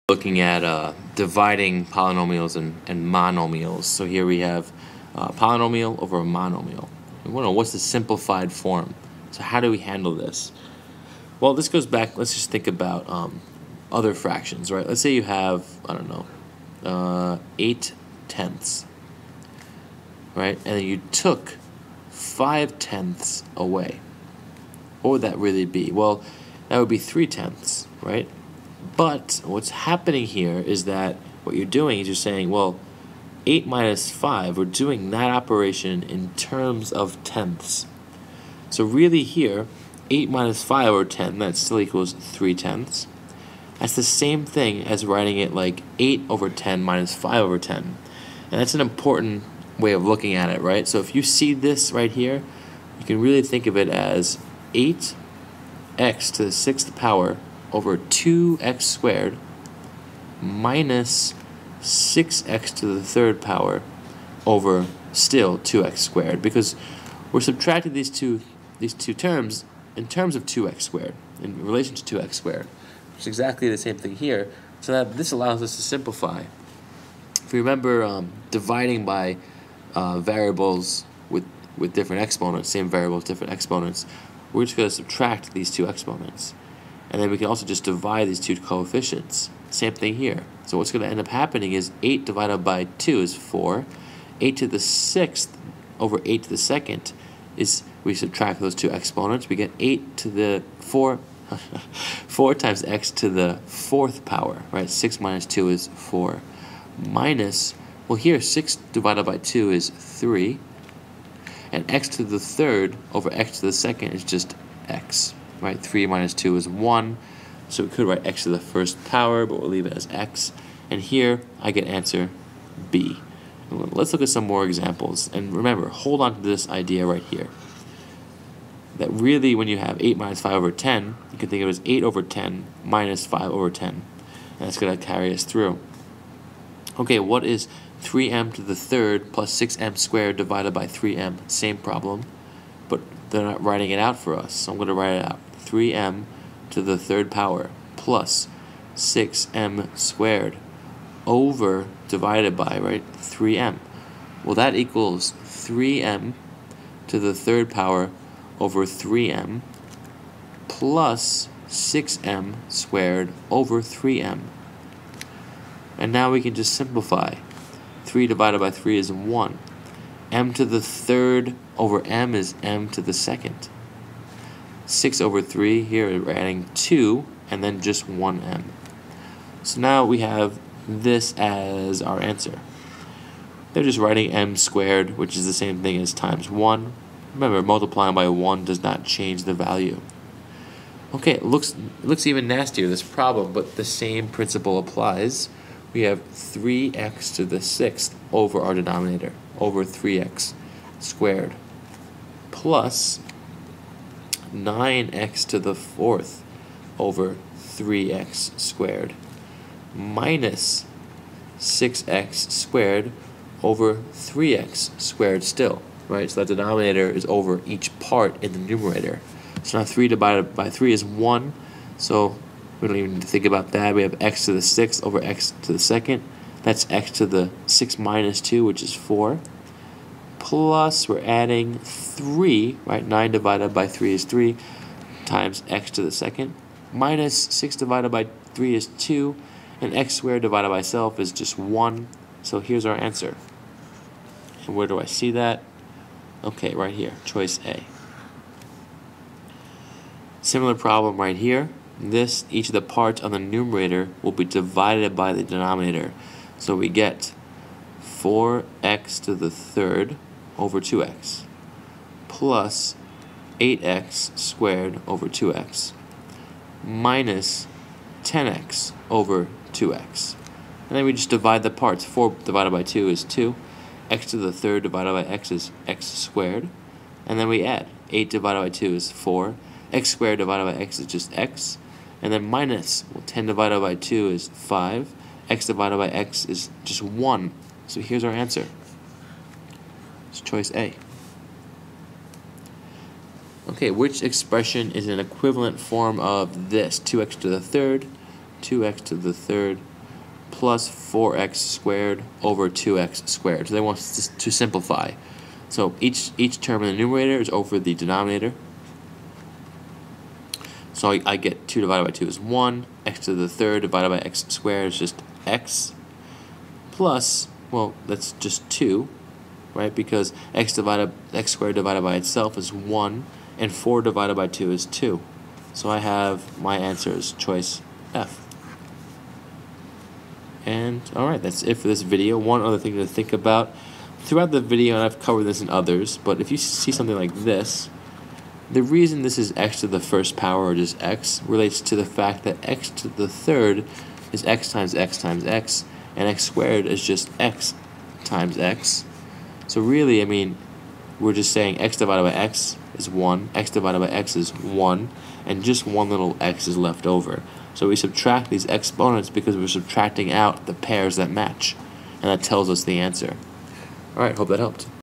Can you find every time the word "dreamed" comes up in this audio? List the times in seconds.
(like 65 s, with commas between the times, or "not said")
not said.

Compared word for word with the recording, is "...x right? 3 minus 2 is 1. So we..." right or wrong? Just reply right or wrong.
right.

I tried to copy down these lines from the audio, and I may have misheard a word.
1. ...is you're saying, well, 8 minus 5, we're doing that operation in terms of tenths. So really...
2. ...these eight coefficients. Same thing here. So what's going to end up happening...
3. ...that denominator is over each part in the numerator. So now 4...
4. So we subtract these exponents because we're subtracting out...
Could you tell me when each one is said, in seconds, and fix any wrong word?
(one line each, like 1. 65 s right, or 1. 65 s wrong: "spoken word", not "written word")
1. 31 s right
2. 88 s wrong: "two", not "eight"
3. 216 s wrong: "3", not "4"
4. 357 s right.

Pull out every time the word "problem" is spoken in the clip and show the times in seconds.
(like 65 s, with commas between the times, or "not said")
141 s, 193 s, 250 s.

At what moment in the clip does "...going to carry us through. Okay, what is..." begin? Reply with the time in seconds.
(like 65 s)
134 s.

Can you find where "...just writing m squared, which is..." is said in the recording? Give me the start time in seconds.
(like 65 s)
183 s.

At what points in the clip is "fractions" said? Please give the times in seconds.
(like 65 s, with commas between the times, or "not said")
14 s.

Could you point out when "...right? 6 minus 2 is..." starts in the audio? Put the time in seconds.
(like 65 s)
104 s.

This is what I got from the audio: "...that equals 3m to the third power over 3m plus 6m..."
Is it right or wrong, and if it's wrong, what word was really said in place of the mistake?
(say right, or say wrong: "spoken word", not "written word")
right.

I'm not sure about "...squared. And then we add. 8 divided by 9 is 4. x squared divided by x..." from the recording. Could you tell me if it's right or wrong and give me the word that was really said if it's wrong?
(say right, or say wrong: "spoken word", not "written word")
wrong: "2", not "9".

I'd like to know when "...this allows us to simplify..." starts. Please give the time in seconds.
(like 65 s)
75 s.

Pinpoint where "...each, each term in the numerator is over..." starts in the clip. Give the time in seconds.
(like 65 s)
305 s.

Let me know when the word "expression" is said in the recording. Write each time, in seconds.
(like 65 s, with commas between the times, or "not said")
294 s.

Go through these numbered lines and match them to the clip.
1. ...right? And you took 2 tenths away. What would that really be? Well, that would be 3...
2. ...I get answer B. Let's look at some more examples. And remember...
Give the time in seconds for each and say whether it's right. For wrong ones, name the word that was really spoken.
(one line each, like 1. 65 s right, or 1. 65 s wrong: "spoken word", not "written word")
1. 20 s wrong: "5", not "2"
2. 121 s right.